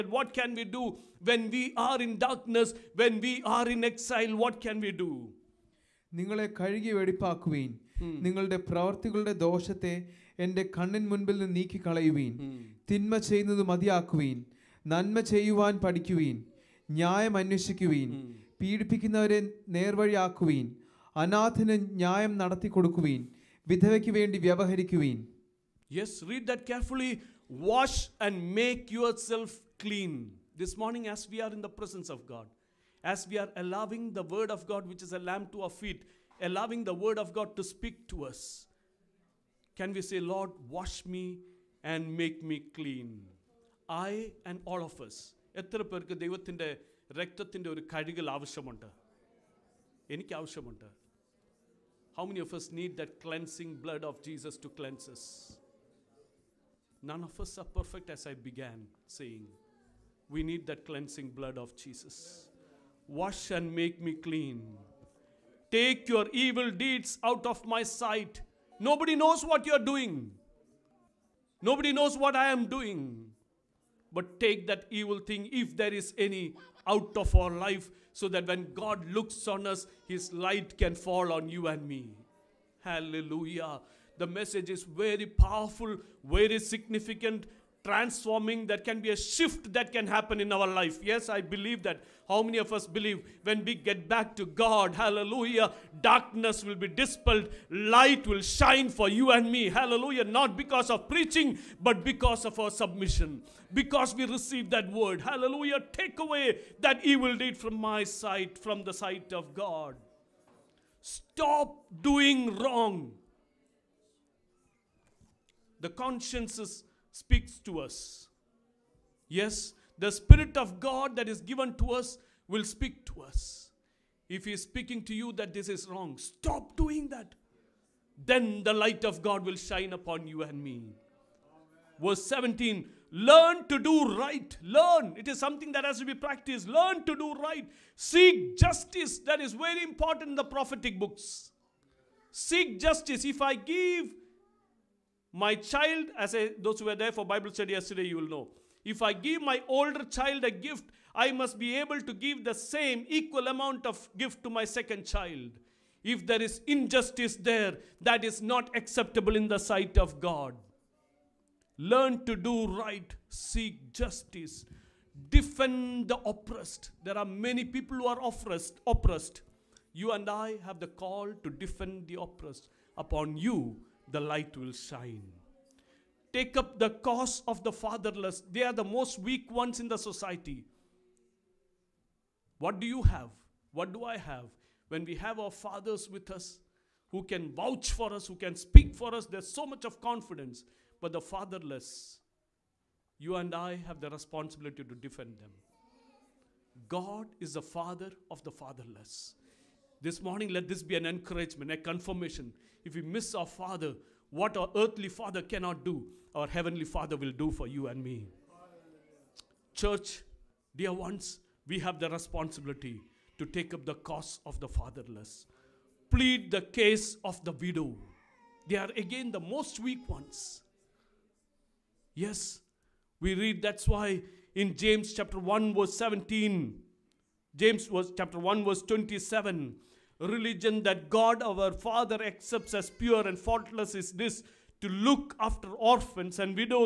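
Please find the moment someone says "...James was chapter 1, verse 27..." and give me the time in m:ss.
3:47.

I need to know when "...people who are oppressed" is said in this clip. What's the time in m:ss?
2:47.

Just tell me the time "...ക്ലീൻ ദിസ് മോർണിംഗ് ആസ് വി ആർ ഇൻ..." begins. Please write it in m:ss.
0:29.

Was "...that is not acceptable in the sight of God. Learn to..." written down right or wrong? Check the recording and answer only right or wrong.
right.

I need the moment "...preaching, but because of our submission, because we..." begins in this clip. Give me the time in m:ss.
1:41.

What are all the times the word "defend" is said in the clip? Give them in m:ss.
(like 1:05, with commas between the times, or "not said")
2:45, 2:51, 3:14.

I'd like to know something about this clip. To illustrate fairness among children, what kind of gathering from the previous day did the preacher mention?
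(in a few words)
Bible study.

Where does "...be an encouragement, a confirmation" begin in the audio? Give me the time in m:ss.
3:20.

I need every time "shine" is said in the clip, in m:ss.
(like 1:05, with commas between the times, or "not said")
1:38, 2:09, 2:54.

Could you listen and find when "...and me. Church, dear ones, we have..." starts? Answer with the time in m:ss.
3:27.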